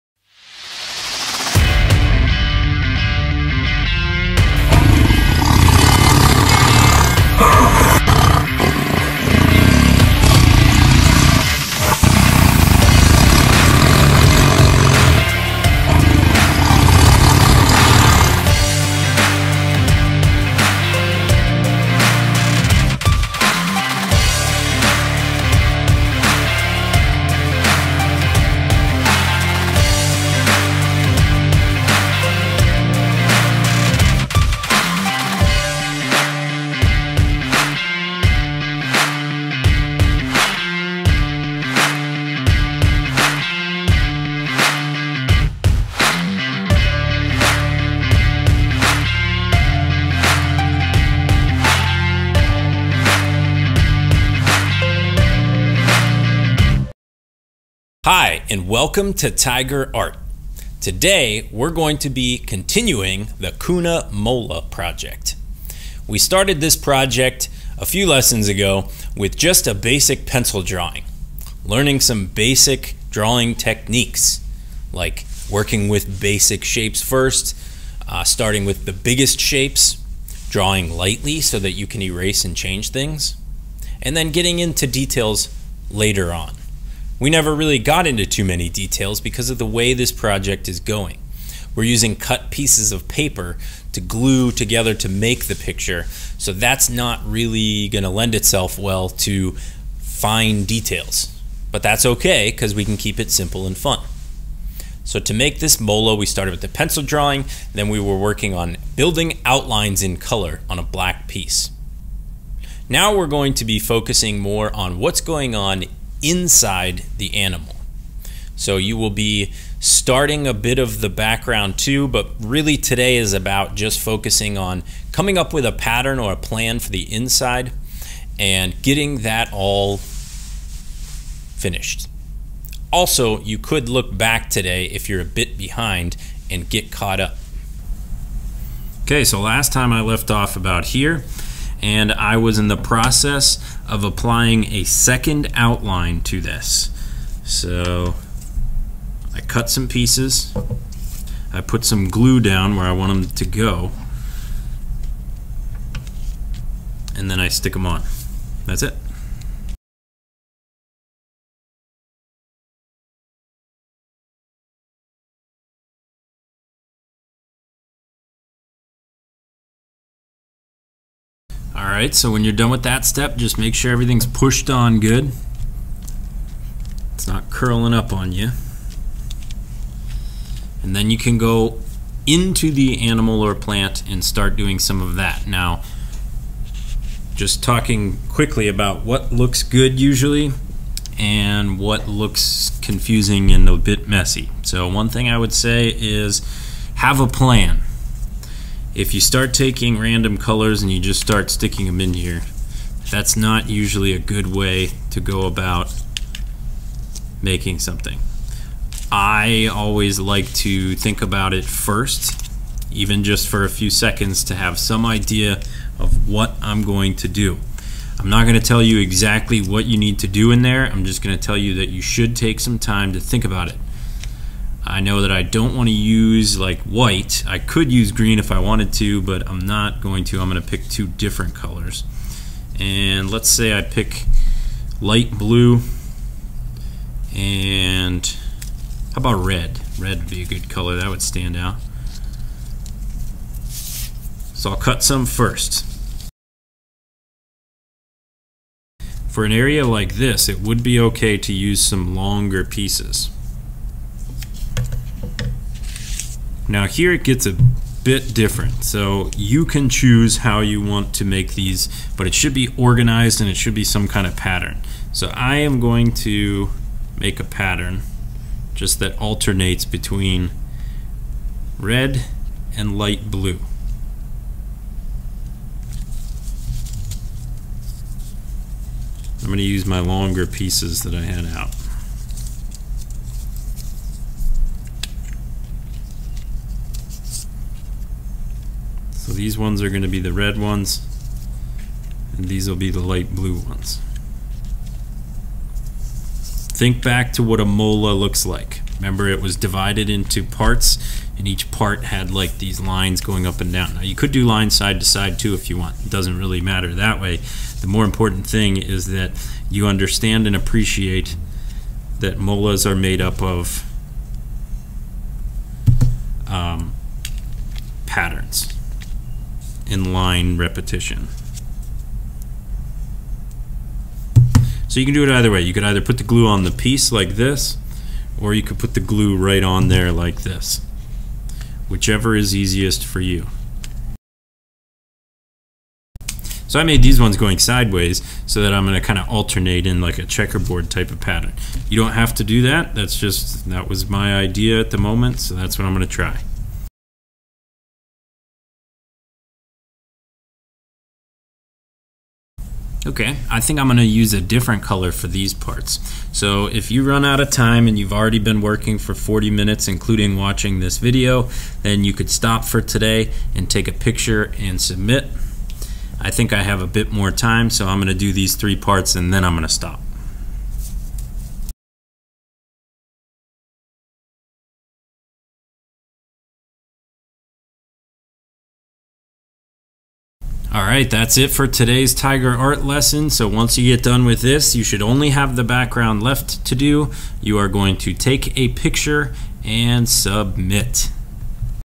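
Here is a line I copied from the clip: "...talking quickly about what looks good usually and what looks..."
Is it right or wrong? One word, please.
right.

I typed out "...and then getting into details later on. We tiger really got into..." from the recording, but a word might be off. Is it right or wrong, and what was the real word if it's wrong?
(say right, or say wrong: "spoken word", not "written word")
wrong: "never", not "tiger".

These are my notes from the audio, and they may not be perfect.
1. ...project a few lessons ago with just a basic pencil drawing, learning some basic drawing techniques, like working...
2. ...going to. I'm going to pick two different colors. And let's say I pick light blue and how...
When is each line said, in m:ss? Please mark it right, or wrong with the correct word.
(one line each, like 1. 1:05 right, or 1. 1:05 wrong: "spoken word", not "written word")
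1. 1:06 right
2. 3:50 right.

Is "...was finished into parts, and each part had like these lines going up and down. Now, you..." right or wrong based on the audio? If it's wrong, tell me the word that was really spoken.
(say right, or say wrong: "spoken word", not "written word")
wrong: "divided", not "finished".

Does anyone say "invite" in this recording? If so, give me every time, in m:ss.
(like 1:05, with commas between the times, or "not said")
not said.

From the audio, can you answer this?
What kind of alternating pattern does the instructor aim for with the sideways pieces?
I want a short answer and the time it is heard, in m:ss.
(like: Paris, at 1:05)
checkerboard, at 5:40.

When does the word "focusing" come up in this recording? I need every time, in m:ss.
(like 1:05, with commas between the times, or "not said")
1:53, 2:03.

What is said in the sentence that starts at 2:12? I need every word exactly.
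Also, you could look back today if you're a bit behind and get caught up.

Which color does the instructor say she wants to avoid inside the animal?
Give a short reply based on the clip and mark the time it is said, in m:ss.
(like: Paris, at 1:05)
white, at 3:46.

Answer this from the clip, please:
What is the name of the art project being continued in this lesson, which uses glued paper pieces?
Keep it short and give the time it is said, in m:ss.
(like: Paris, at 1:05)
Kuna Mola, at 1:03.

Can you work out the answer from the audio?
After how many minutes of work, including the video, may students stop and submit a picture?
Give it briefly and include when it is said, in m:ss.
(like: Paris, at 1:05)
40, at 5:59.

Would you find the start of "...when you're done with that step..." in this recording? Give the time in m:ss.
2:52.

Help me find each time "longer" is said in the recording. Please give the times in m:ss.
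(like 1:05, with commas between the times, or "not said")
4:12, 4:39.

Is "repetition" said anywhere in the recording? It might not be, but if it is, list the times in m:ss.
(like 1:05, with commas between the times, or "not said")
5:20.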